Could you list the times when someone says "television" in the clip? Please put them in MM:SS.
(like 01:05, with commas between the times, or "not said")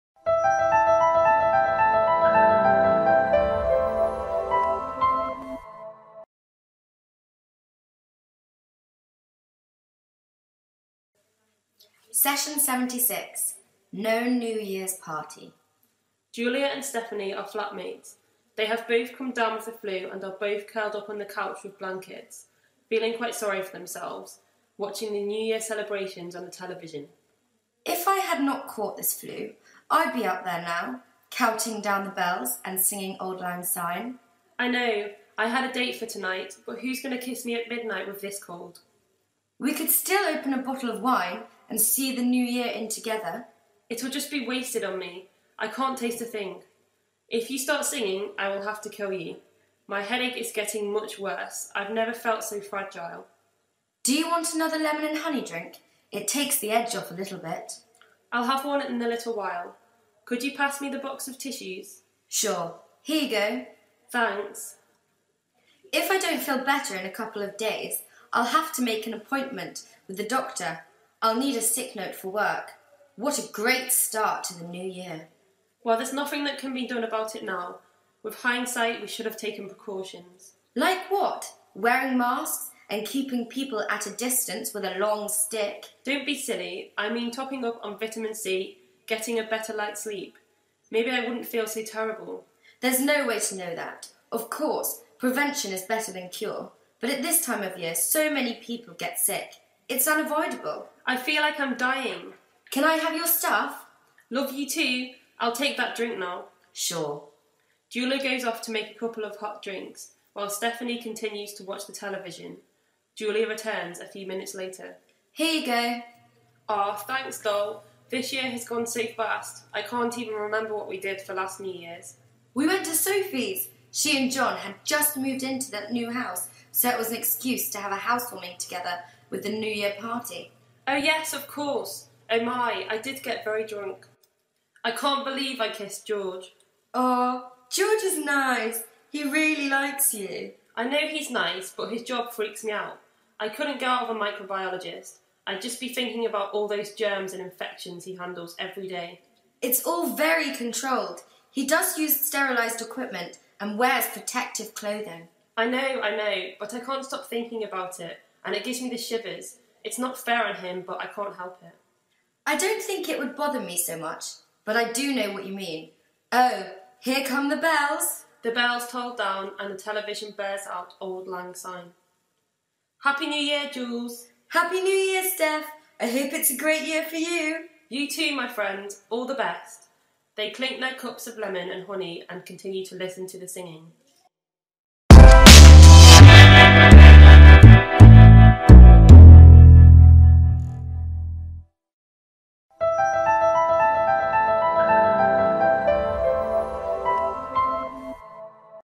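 00:26, 01:51, 02:49.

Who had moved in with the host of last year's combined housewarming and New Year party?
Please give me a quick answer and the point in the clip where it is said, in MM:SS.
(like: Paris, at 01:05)
John, at 02:04.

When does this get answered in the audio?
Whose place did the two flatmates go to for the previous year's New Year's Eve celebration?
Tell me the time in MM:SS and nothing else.
02:02.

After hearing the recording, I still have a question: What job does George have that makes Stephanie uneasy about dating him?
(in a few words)
Microbiologist.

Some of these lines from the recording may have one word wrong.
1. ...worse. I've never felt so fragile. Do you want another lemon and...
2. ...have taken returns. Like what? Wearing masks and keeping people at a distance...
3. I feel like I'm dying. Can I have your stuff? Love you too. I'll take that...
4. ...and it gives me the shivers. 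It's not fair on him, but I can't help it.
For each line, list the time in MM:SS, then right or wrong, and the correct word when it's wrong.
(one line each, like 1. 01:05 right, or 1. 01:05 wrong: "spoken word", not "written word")
1. 00:51 right
2. 01:19 wrong: "precautions", not "returns"
3. 01:41 right
4. 02:38 right.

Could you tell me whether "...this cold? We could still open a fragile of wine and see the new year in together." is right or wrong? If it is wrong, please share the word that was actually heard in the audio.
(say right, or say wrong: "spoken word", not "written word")
wrong: "bottle", not "fragile".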